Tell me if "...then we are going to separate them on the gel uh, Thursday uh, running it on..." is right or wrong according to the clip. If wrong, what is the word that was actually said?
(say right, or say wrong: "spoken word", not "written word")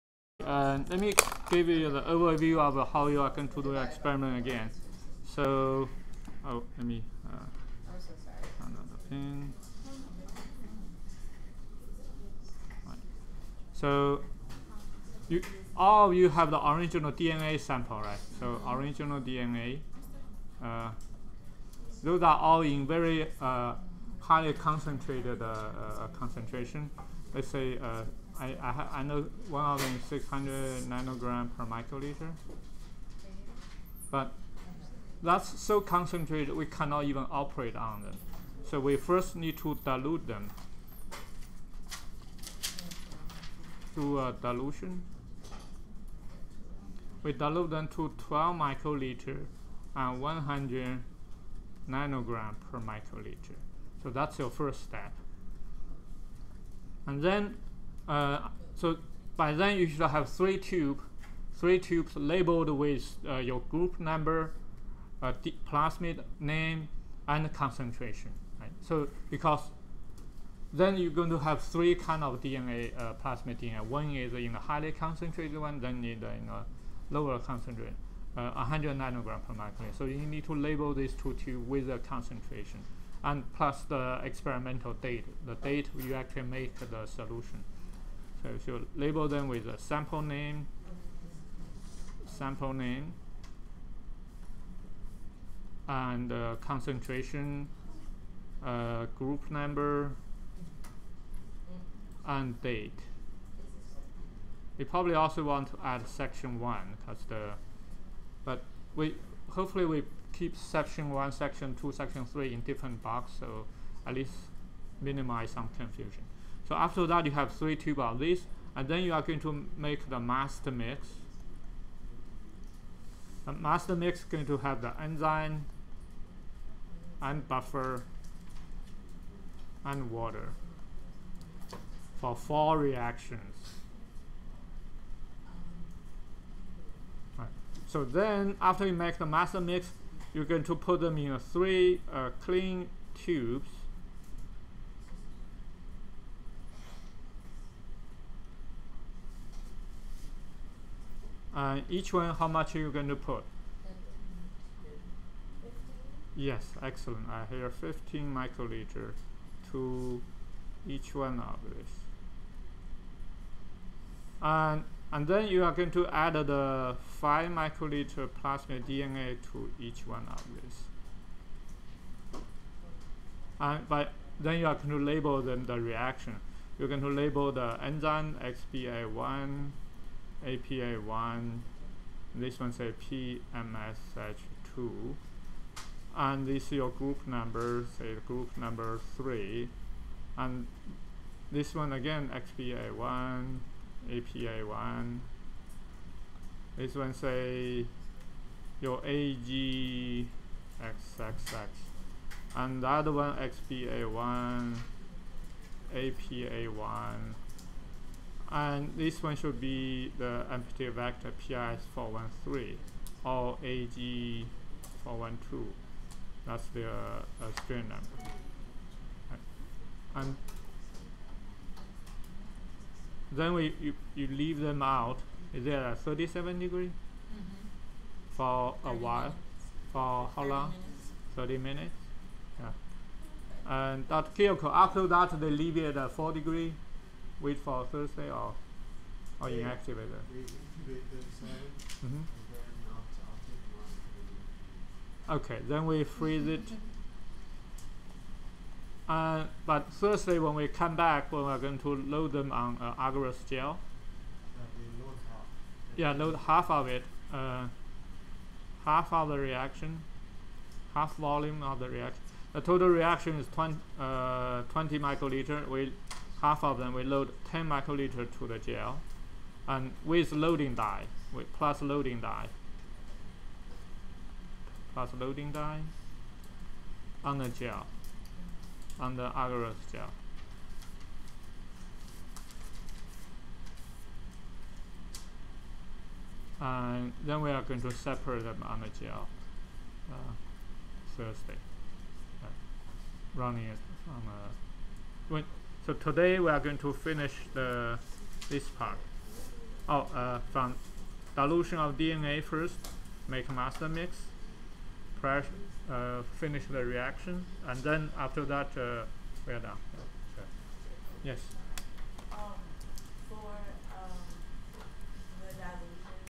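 right.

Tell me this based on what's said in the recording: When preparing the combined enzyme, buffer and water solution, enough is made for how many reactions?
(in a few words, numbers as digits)
4.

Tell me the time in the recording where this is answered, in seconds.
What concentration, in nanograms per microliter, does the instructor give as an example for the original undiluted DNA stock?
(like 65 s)
29 s.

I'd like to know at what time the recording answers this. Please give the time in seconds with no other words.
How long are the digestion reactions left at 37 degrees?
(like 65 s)
230 s.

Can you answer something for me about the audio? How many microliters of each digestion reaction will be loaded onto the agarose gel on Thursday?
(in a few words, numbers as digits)
10 microliters.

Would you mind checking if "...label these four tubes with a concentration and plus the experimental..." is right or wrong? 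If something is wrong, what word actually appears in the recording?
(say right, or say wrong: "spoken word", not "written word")
wrong: "two", not "four".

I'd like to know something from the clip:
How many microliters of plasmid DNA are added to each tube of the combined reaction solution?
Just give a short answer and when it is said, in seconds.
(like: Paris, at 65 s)
5 microliters, at 167 s.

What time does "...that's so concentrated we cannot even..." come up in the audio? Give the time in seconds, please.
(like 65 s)
35 s.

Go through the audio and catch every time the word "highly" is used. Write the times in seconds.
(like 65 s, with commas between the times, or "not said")
24 s, 74 s.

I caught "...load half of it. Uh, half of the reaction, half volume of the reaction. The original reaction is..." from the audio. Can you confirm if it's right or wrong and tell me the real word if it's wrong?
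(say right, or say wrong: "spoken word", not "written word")
wrong: "total", not "original".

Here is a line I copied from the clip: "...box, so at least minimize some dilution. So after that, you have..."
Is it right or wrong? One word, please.
wrong.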